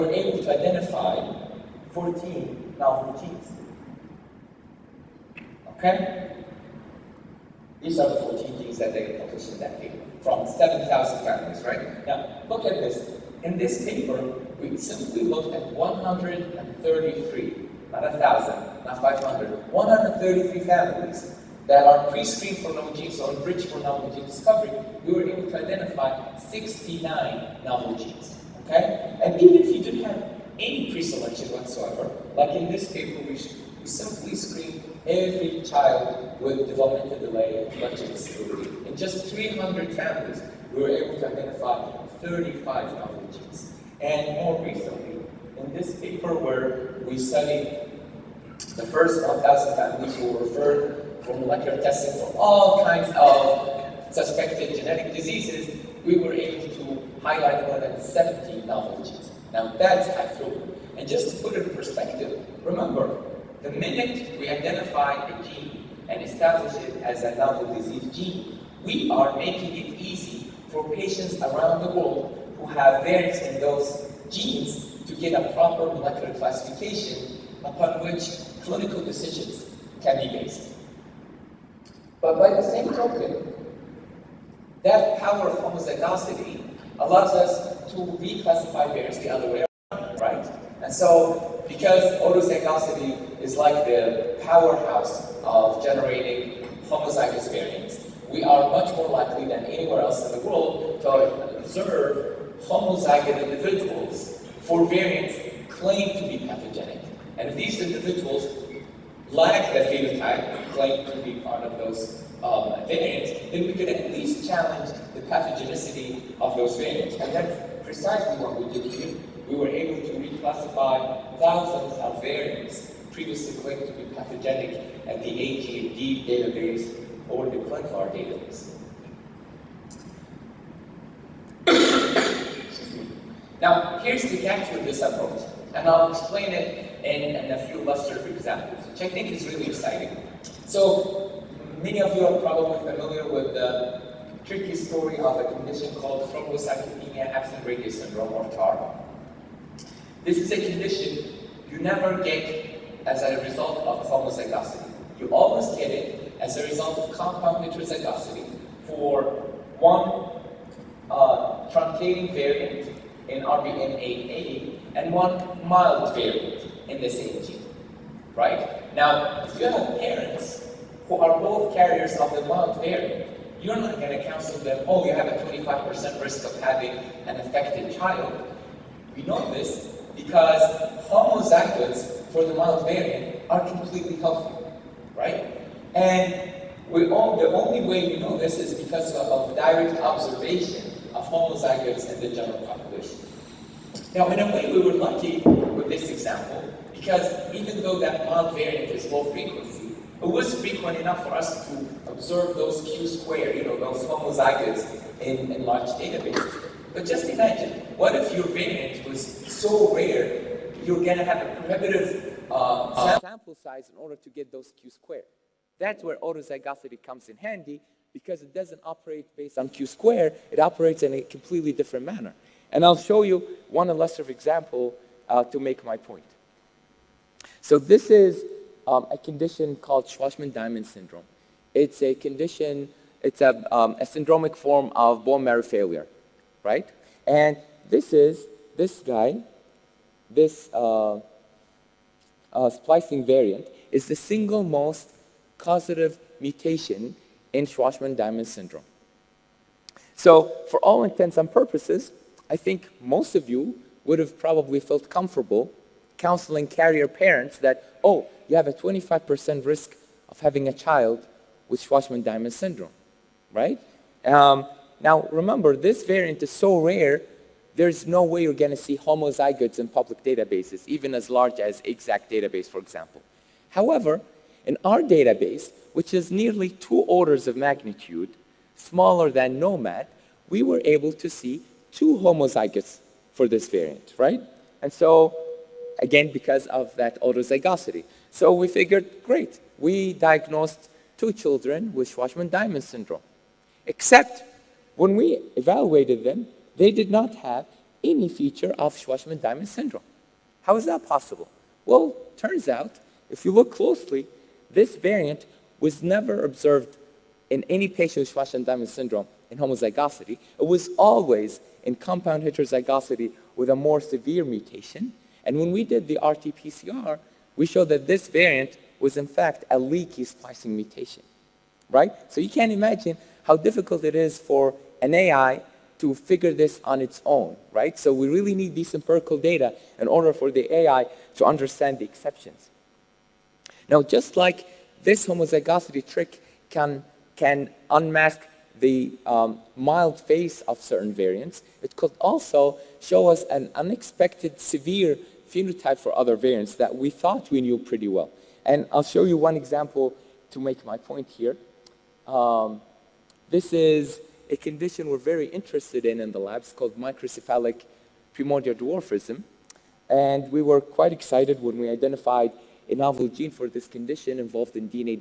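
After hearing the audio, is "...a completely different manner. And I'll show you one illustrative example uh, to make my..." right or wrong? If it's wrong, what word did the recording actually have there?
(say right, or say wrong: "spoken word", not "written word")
right.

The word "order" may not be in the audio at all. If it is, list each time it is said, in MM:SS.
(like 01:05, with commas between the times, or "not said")
03:33, 04:36, 05:30.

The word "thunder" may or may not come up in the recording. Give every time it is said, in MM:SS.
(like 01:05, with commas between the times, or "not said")
not said.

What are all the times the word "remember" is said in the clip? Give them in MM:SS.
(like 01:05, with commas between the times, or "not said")
01:02, 04:25.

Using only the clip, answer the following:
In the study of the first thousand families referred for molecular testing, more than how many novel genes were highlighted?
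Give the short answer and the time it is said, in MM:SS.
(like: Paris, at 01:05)
70, at 00:57.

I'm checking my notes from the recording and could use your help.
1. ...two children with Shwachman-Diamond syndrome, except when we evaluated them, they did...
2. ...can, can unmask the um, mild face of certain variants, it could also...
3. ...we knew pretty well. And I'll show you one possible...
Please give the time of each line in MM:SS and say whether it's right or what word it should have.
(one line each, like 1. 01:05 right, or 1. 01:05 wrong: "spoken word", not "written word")
1. 04:51 right
2. 05:36 right
3. 05:47 wrong: "example", not "possible".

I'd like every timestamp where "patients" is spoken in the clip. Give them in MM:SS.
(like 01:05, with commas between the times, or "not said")
01:10, 05:07.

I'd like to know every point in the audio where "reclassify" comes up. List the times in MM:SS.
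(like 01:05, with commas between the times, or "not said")
01:27, 02:00.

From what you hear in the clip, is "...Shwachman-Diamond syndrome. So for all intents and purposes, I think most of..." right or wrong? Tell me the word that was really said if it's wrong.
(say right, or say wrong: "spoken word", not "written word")
right.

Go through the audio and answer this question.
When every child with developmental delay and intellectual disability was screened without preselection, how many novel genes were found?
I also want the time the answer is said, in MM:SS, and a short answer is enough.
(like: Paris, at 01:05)
35, at 00:42.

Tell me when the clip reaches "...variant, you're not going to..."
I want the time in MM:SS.
02:52.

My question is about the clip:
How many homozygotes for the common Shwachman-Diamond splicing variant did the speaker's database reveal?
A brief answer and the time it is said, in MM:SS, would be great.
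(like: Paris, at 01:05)
2, at 04:41.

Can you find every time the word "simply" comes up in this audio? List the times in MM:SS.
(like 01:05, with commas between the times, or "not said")
00:14, 00:33.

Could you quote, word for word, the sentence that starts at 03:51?
It's a condition, it's a, um, a syndromic form of bone marrow failure right?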